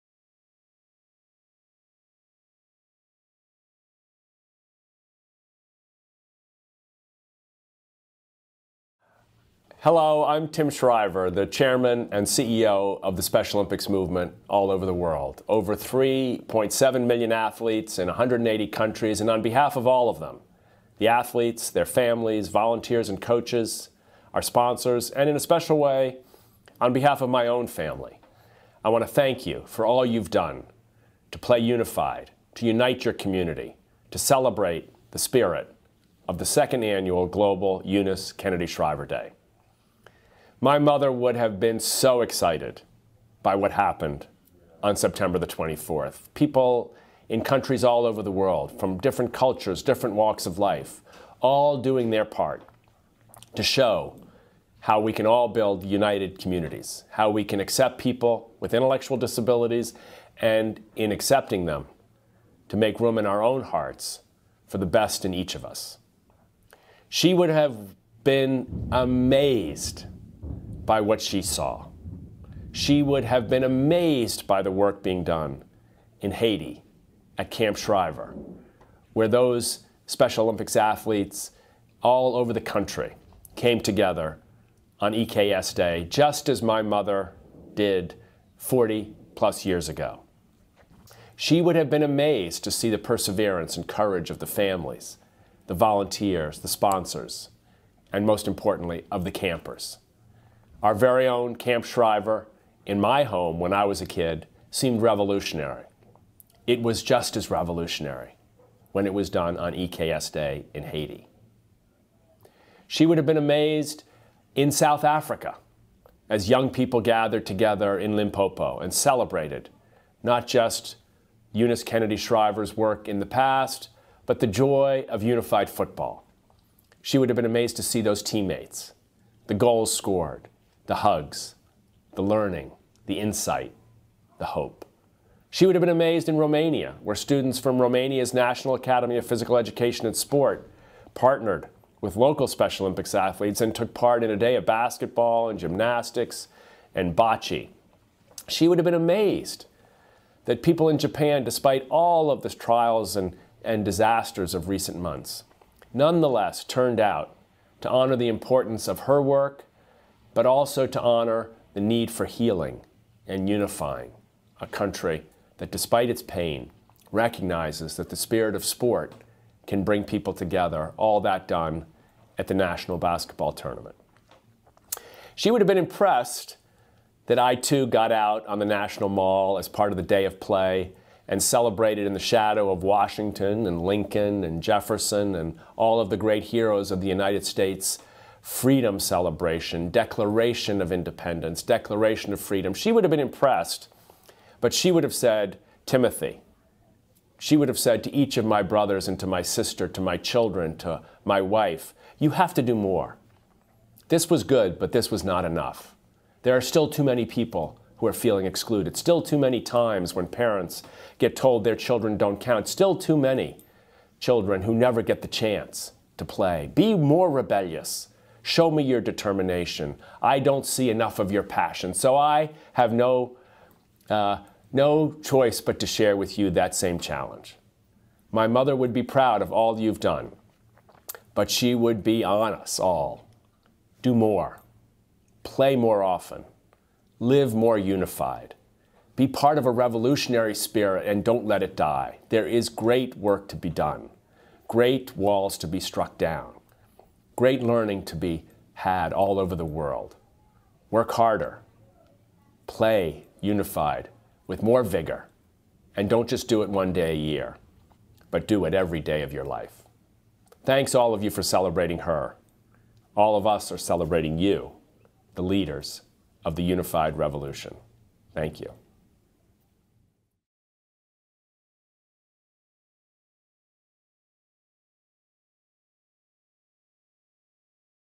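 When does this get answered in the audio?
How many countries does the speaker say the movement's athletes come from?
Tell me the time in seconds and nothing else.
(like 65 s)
18 s.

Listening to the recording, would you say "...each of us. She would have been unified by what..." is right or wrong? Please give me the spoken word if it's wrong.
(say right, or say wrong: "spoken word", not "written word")
wrong: "amazed", not "unified".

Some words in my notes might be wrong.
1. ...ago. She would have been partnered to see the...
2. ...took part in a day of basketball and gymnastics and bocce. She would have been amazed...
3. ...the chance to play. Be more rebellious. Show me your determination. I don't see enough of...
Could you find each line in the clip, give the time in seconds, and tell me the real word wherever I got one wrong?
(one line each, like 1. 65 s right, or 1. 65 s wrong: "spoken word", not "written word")
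1. 89 s wrong: "amazed", not "partnered"
2. 143 s right
3. 215 s right.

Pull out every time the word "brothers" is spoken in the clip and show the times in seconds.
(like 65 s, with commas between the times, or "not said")
198 s.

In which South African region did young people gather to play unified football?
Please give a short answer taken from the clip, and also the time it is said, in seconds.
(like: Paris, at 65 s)
Limpopo, at 118 s.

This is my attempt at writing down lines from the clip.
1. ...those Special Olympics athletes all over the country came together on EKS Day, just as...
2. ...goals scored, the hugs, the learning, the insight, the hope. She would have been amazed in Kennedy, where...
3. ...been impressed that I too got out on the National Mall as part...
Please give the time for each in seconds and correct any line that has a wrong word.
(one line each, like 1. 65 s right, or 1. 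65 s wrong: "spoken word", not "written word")
1. 79 s right
2. 129 s wrong: "Romania", not "Kennedy"
3. 175 s right.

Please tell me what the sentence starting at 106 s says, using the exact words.
It was just as revolutionary when it was done on EKS Day in Haiti.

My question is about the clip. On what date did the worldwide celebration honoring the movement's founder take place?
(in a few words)
September 24.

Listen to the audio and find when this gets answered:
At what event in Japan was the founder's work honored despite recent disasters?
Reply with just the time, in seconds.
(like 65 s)
172 s.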